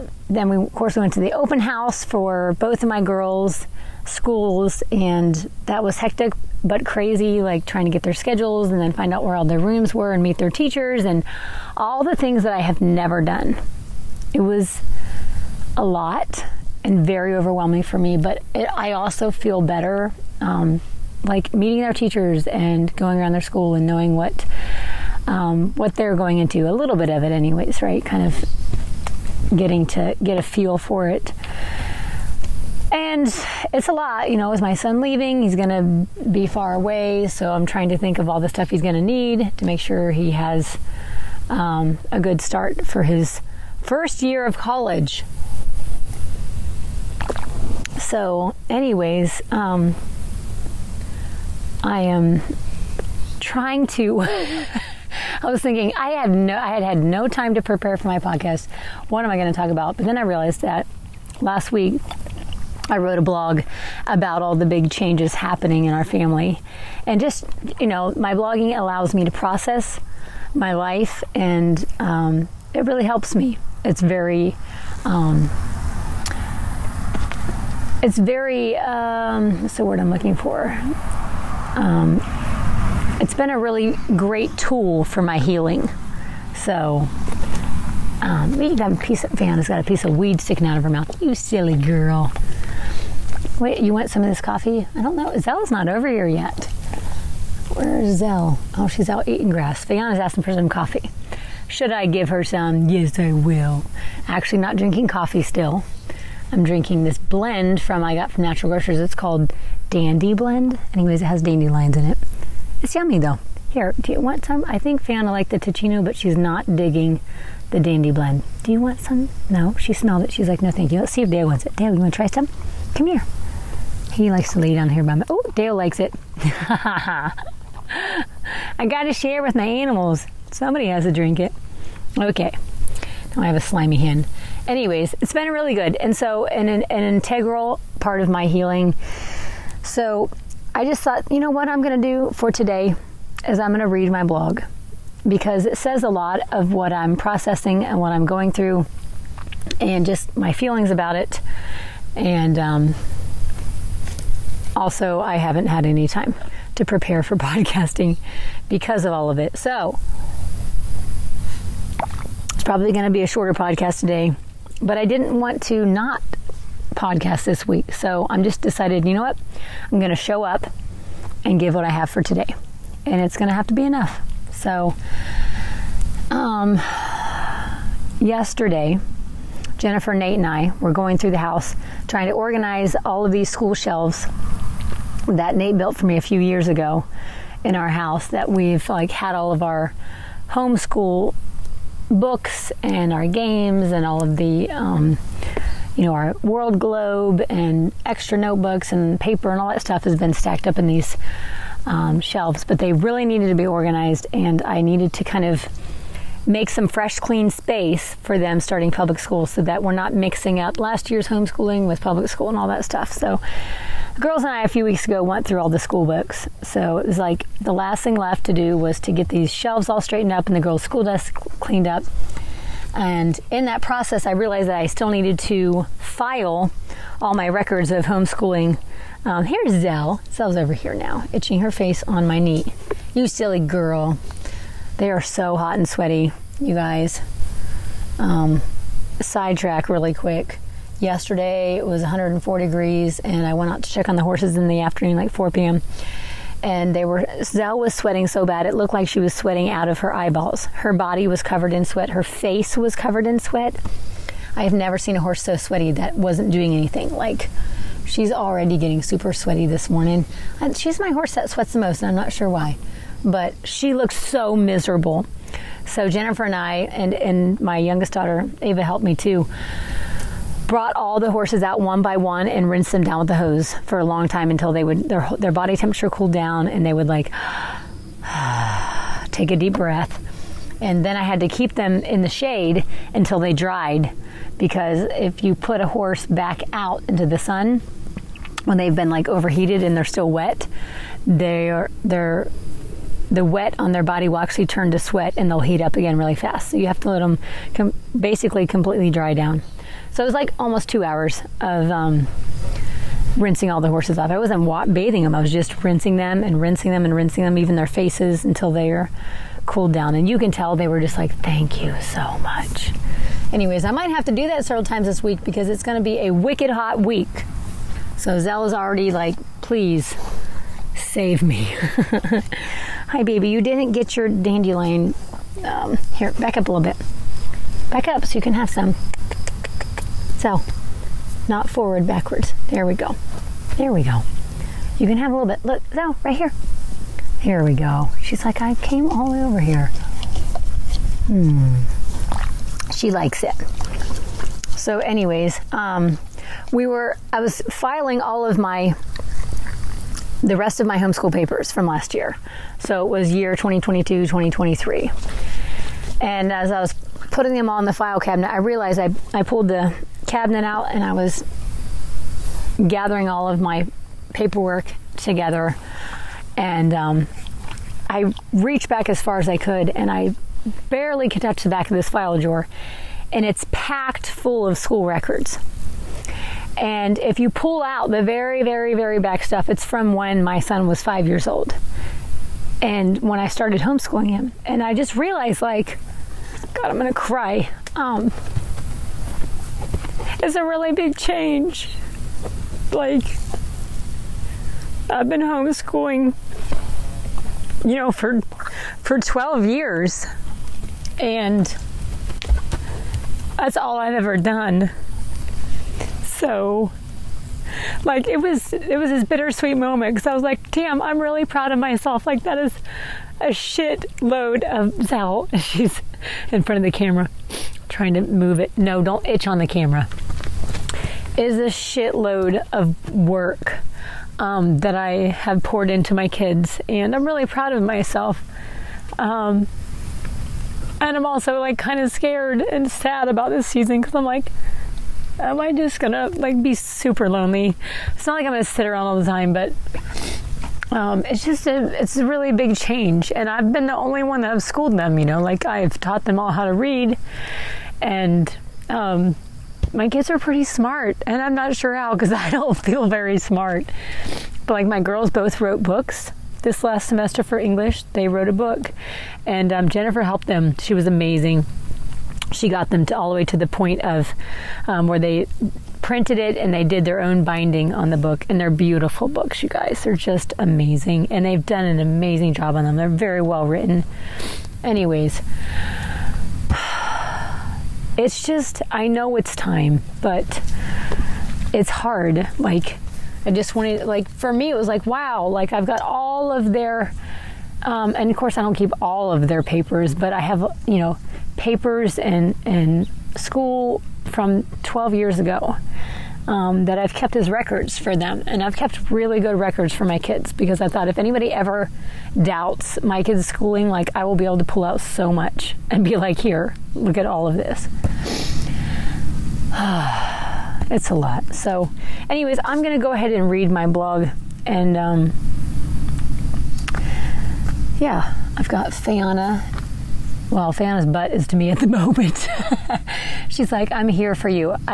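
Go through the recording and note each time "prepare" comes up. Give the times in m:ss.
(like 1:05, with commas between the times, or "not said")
0:57, 2:36.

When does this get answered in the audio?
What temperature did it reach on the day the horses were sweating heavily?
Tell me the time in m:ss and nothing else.
4:02.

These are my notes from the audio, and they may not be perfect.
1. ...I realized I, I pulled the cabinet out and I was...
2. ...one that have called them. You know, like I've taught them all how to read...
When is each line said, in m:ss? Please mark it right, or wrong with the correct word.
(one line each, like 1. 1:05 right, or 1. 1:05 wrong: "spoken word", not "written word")
1. 5:58 right
2. 7:24 wrong: "schooled", not "called".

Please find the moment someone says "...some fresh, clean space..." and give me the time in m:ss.
3:26.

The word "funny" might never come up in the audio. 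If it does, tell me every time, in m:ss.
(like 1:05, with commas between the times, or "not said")
not said.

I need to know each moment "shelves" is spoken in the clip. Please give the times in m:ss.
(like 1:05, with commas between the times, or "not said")
3:03, 3:22, 3:39.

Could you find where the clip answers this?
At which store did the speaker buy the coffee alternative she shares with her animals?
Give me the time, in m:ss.
1:48.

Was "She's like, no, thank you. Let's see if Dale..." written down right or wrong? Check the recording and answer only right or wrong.
right.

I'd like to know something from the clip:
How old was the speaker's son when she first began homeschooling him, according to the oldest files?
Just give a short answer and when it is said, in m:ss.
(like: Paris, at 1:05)
5, at 6:21.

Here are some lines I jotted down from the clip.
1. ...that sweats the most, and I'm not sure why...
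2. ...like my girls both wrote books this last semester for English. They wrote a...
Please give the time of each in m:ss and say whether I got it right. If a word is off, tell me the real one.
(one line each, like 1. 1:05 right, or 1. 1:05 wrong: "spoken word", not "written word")
1. 4:21 right
2. 7:34 right.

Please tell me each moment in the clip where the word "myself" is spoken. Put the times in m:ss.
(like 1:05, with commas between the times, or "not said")
6:51, 7:07.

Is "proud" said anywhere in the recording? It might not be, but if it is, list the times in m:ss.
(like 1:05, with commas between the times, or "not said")
6:51, 7:07.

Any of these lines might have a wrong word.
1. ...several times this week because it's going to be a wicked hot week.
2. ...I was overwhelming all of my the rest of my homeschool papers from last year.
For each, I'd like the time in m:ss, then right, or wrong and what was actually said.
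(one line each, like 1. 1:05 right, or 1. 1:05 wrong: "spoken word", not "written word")
1. 5:14 right
2. 5:47 wrong: "filing", not "overwhelming".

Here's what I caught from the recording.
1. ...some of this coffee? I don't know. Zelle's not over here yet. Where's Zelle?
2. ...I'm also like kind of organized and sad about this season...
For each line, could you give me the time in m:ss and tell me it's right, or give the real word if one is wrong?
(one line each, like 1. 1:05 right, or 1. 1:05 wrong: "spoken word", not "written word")
1. 1:34 right
2. 7:11 wrong: "scared", not "organized".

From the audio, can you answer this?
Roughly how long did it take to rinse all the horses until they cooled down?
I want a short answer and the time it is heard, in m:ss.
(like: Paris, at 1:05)
Almost two hours, at 5:00.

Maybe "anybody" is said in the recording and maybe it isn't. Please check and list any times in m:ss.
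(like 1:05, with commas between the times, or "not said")
8:21.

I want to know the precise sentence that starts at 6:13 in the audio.
And it's packed full of school records.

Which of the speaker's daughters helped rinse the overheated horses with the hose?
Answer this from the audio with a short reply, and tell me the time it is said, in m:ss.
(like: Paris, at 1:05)
Ava, at 4:28.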